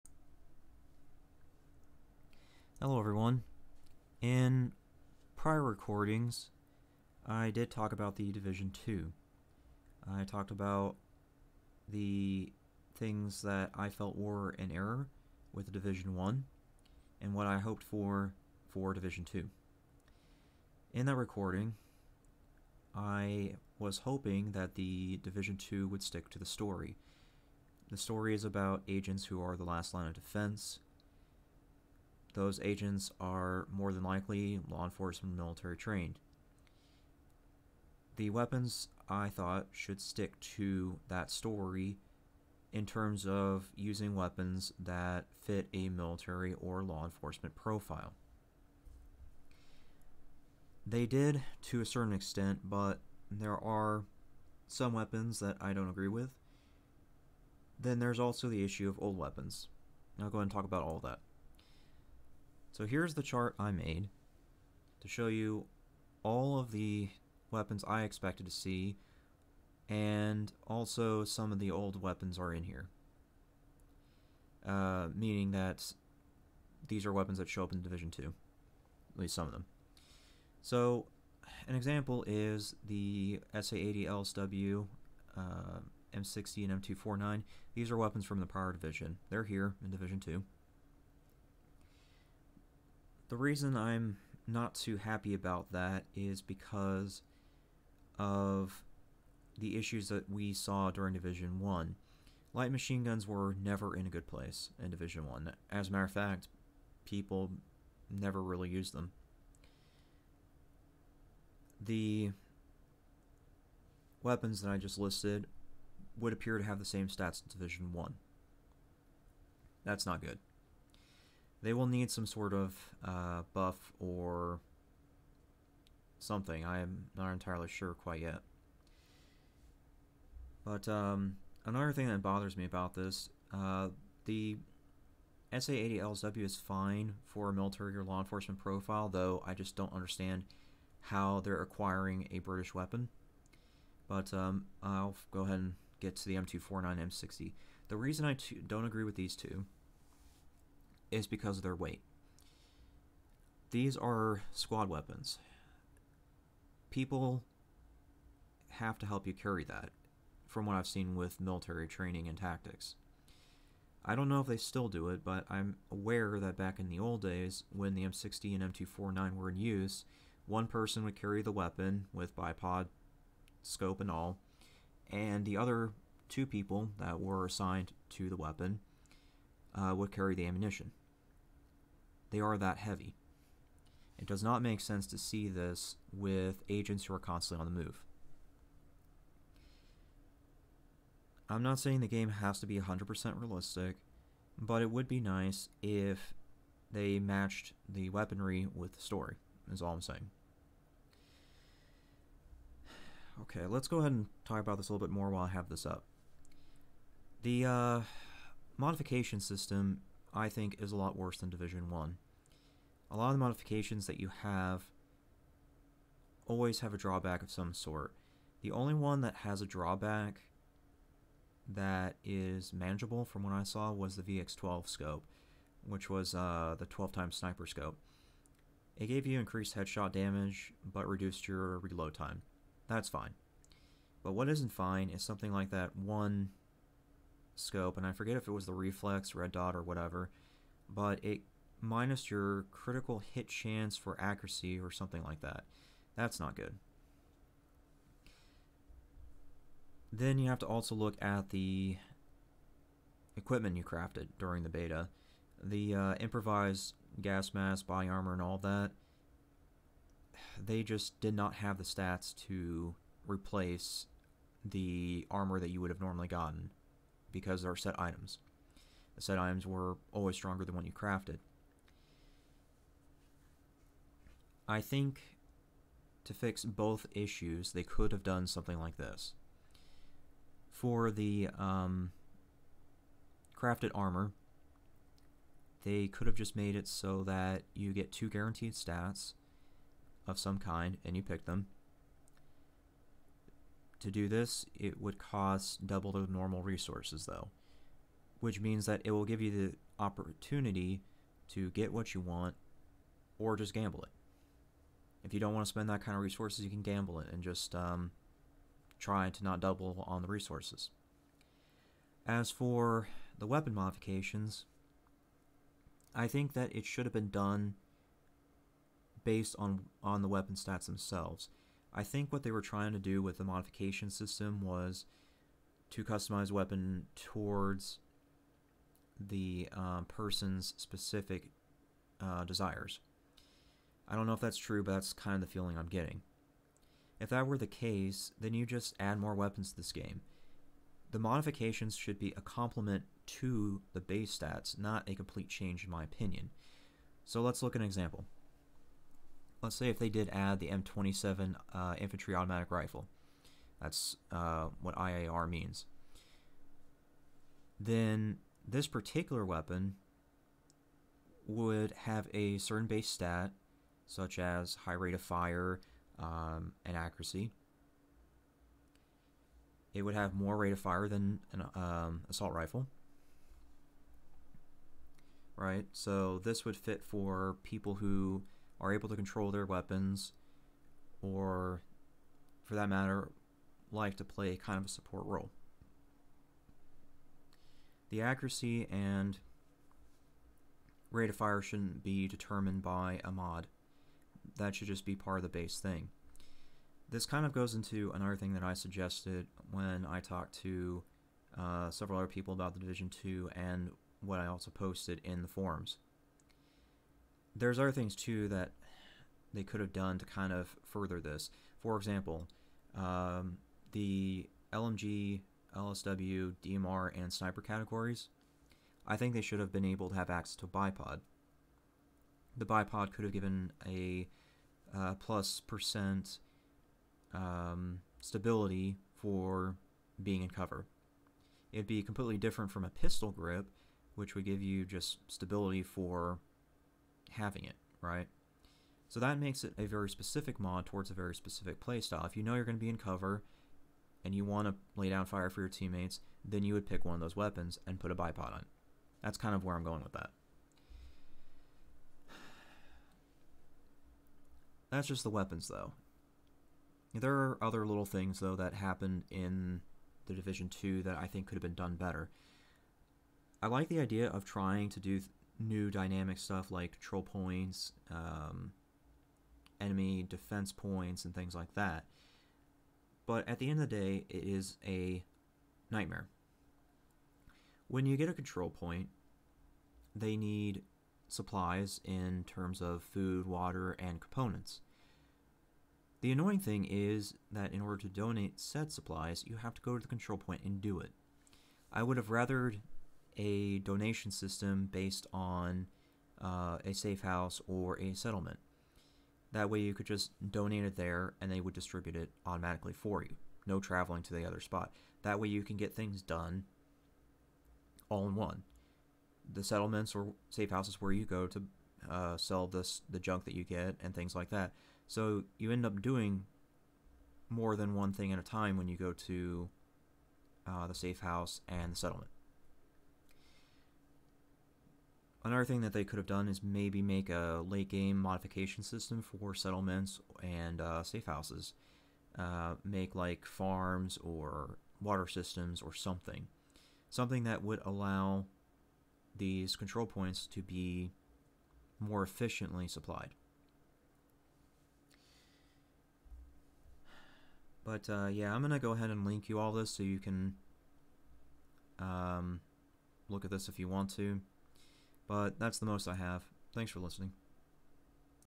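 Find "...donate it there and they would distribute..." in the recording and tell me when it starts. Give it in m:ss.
8:20.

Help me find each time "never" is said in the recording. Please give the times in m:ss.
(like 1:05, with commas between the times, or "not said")
1:43, 1:48.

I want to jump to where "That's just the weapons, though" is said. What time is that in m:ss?
7:34.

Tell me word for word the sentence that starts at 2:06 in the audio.
I am not entirely sure quite yet.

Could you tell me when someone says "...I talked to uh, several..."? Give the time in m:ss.
6:40.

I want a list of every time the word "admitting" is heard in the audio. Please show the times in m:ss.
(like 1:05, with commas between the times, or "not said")
not said.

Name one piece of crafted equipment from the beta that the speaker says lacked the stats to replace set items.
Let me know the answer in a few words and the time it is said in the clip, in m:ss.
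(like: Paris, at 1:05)
Improvised gas mask, at 4:16.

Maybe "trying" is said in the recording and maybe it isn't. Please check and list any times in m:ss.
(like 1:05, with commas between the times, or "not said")
5:22, 7:44.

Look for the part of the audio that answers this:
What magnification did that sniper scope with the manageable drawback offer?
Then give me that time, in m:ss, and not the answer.
3:46.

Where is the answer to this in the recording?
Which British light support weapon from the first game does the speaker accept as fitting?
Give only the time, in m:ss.
2:15.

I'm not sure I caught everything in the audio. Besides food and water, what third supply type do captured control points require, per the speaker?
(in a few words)
Components.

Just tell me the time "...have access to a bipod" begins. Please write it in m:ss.
7:00.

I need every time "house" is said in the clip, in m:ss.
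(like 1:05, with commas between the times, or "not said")
8:17, 8:30, 8:41, 8:51.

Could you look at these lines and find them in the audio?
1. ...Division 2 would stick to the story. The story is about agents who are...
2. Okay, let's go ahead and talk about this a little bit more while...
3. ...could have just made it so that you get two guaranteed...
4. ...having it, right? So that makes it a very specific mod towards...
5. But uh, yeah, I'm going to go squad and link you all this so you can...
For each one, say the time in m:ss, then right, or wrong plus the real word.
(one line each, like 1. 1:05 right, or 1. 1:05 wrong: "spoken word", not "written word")
1. 0:25 right
2. 3:23 right
3. 4:46 right
4. 7:17 right
5. 9:07 wrong: "ahead", not "squad".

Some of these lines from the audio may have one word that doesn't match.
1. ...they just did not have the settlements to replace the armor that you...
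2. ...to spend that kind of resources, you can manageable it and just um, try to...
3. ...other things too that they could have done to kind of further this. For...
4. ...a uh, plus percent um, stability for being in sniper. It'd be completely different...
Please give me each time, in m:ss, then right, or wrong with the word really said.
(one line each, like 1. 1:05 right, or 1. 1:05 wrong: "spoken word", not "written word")
1. 4:20 wrong: "stats", not "settlements"
2. 5:05 wrong: "gamble", not "manageable"
3. 6:47 right
4. 7:03 wrong: "cover", not "sniper".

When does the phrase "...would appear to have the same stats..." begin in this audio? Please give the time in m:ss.
1:56.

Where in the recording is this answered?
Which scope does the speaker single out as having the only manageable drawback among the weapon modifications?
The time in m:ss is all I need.
3:44.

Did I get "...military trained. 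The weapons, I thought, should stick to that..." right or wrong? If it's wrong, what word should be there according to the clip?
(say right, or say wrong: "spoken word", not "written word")
right.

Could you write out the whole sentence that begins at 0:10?
I talked about the things that I felt were an error with Division 1 and what I hoped for for Division 2.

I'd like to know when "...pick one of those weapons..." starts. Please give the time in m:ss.
7:26.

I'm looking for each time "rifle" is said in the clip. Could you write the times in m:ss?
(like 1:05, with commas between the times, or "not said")
5:52, 6:12.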